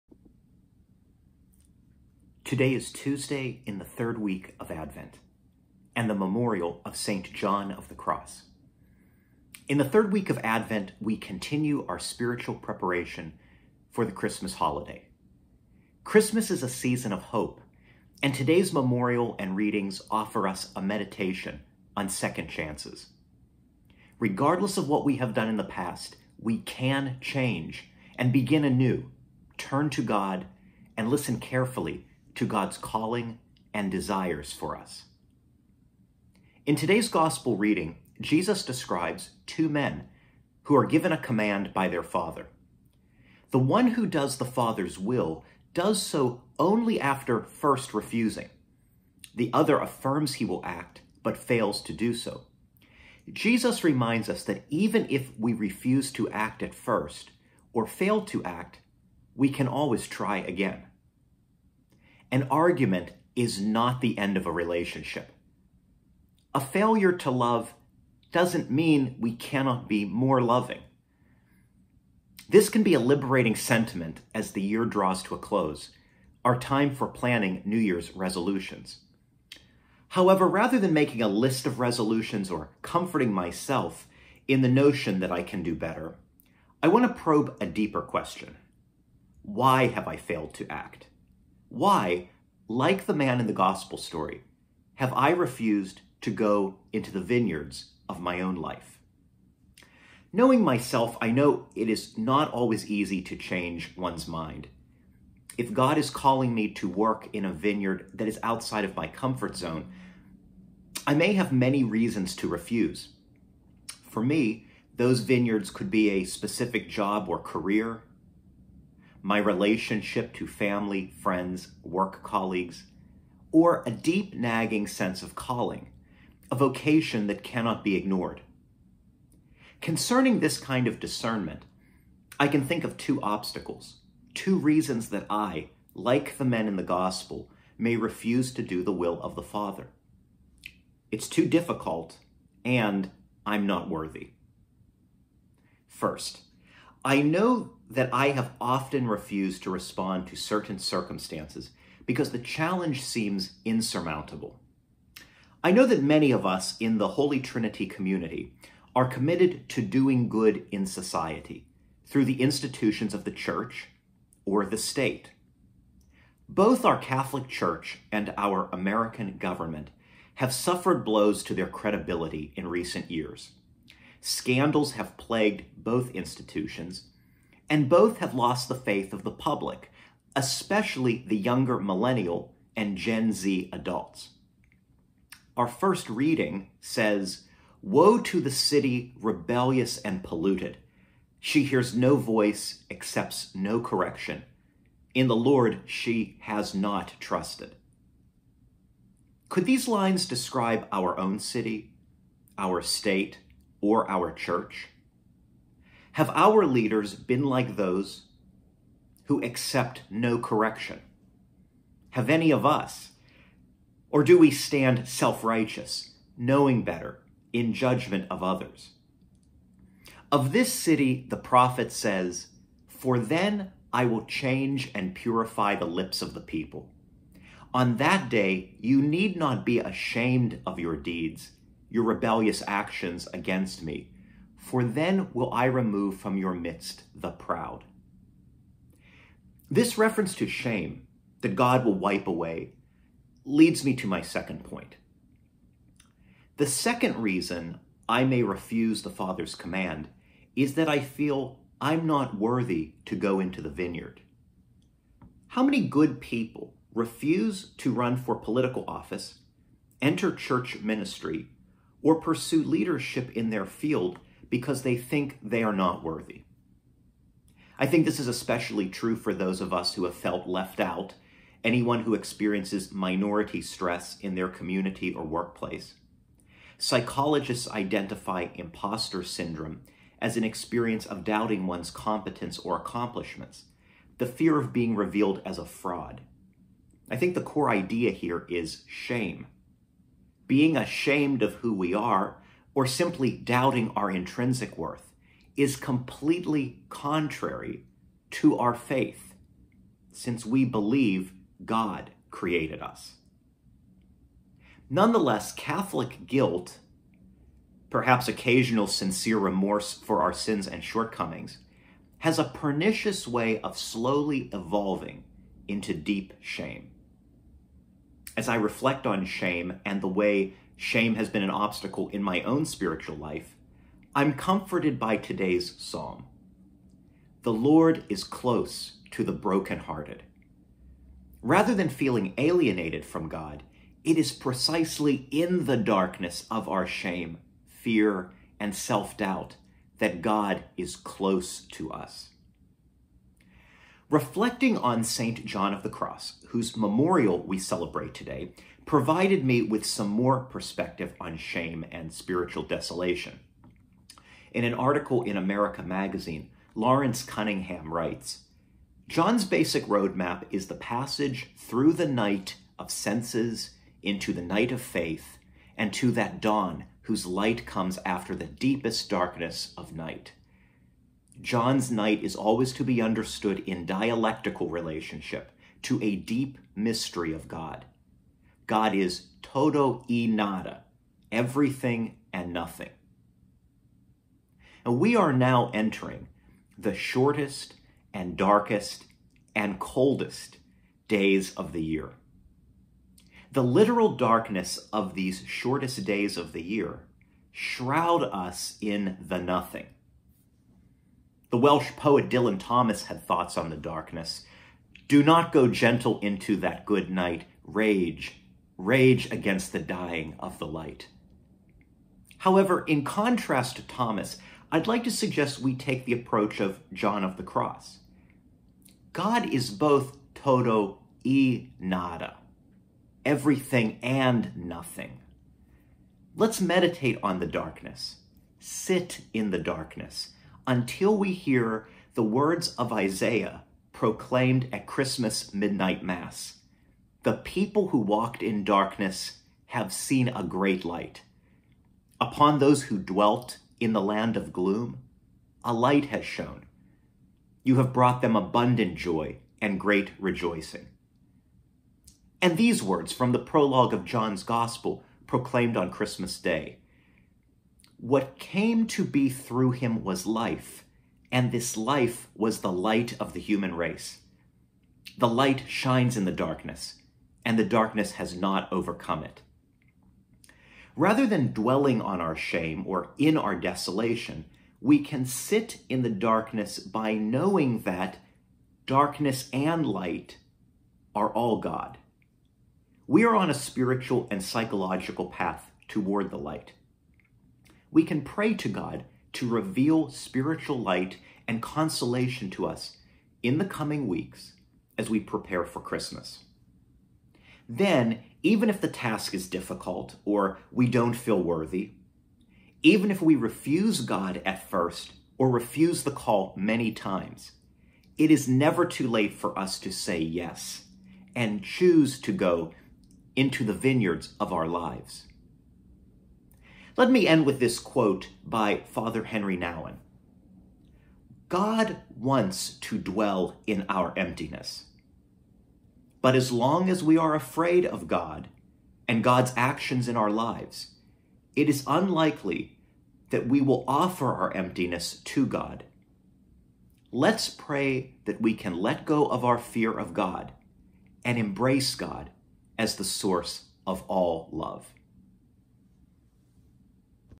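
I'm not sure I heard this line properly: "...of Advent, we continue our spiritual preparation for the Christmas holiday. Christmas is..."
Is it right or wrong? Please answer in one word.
right.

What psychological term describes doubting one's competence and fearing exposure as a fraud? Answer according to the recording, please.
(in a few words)
imposter syndrome.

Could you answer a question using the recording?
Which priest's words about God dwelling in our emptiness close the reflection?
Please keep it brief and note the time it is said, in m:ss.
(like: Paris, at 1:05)
Henri Nouwen, at 8:39.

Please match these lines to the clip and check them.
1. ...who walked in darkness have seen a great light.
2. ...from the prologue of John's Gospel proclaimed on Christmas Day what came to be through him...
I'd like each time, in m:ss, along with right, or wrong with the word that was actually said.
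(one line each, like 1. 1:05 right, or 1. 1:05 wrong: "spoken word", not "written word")
1. 7:17 right
2. 7:33 right.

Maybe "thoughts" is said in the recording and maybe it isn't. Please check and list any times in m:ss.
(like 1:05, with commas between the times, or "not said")
6:43.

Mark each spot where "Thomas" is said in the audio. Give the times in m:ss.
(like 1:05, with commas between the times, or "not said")
6:42, 6:53.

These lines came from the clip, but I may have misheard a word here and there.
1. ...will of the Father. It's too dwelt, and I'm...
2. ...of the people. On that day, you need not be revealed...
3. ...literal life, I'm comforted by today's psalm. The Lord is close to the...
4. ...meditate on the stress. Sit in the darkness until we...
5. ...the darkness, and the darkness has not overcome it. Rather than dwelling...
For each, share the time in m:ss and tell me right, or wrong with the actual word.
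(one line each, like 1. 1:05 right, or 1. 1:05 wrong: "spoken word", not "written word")
1. 2:18 wrong: "difficult", not "dwelt"
2. 3:46 wrong: "ashamed", not "revealed"
3. 5:22 wrong: "spiritual", not "literal"
4. 7:06 wrong: "darkness", not "stress"
5. 7:46 right.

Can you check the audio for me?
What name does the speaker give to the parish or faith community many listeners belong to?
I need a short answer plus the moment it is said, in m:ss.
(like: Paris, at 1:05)
Holy Trinity, at 2:37.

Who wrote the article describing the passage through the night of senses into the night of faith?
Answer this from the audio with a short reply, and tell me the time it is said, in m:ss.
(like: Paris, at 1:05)
Lawrence Cunningham, at 5:56.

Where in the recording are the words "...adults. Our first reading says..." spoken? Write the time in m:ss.
3:03.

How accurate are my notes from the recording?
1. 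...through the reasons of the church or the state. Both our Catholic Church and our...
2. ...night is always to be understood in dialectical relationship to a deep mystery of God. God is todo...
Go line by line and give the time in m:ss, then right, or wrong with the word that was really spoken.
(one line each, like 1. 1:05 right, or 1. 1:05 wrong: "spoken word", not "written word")
1. 2:42 wrong: "institutions", not "reasons"
2. 6:11 right.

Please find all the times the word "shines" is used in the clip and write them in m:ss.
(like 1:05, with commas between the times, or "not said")
7:45.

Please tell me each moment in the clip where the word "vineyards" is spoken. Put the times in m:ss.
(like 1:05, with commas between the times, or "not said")
1:37, 1:47, 1:55, 4:13, 8:33.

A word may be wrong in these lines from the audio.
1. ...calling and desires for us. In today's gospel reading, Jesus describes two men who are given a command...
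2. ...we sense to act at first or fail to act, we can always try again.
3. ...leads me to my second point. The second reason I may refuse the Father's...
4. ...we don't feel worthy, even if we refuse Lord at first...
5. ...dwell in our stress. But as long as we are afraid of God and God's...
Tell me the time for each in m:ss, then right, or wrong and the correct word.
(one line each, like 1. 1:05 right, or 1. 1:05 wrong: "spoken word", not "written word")
1. 0:32 right
2. 0:55 wrong: "refuse", not "sense"
3. 4:03 right
4. 8:20 wrong: "God", not "Lord"
5. 8:42 wrong: "emptiness", not "stress".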